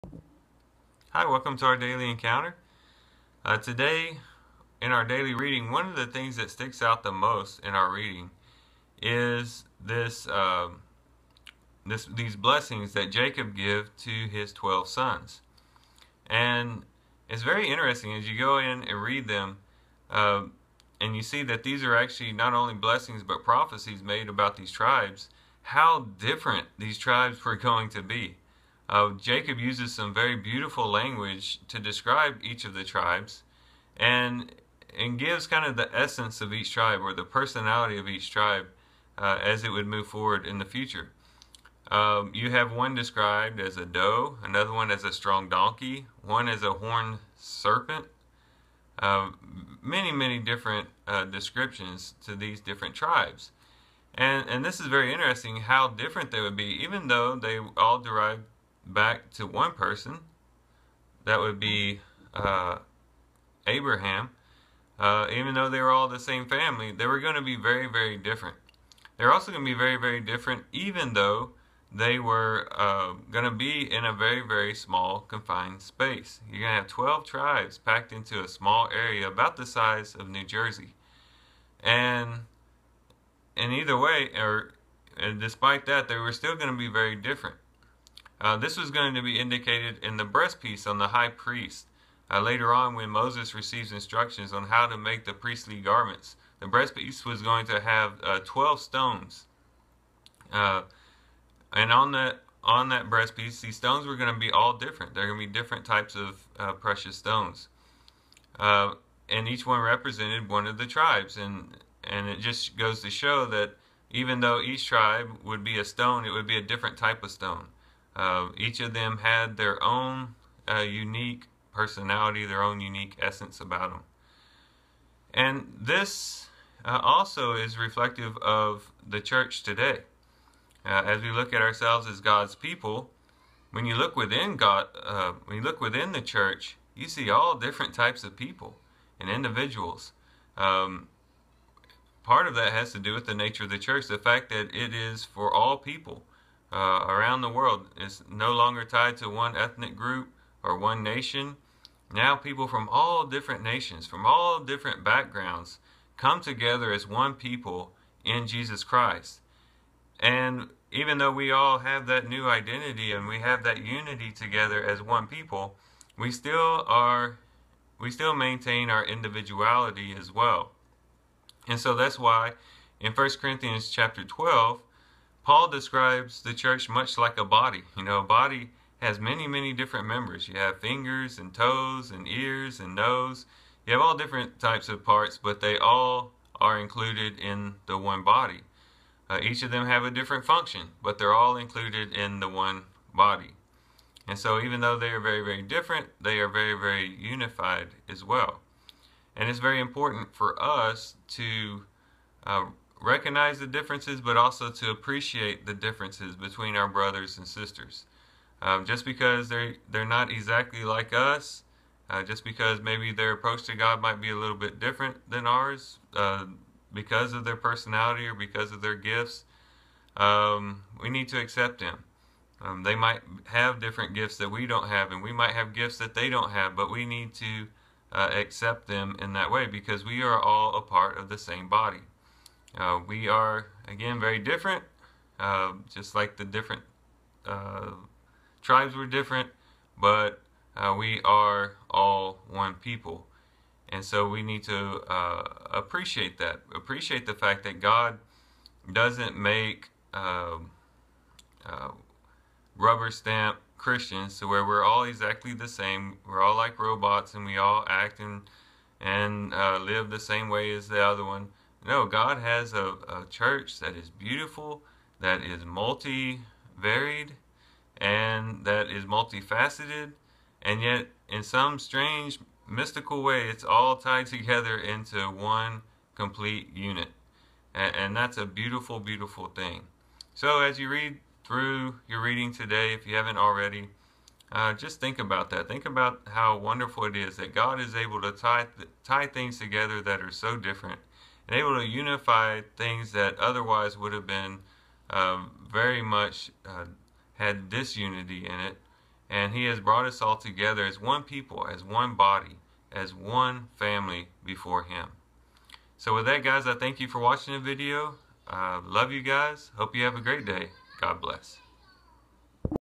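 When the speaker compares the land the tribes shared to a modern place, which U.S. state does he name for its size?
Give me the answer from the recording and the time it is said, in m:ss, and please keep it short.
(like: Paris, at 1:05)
New Jersey, at 1:20.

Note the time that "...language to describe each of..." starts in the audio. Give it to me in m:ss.
0:30.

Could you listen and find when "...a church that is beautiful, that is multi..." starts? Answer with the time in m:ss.
4:23.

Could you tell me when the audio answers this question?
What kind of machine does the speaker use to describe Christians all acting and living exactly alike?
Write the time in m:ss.
4:16.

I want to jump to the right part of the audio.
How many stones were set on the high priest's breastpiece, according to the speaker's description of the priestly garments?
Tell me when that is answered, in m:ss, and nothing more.
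1:38.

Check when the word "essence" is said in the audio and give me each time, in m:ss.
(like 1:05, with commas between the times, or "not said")
0:35, 2:03.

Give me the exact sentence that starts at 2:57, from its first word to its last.
You know, a body has many, many different members.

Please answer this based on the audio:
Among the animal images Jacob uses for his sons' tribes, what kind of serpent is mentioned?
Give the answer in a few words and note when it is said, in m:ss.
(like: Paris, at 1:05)
horned serpent, at 0:46.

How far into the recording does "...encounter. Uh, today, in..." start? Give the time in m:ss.
0:02.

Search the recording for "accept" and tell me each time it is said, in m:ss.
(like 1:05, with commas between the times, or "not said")
3:41, 3:48.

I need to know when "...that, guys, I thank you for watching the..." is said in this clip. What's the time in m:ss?
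5:06.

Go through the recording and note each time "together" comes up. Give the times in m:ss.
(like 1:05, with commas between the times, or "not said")
2:36, 2:44, 4:34, 4:49, 5:00.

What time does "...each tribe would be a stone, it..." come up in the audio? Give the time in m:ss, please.
1:54.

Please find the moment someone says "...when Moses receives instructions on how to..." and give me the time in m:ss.
1:32.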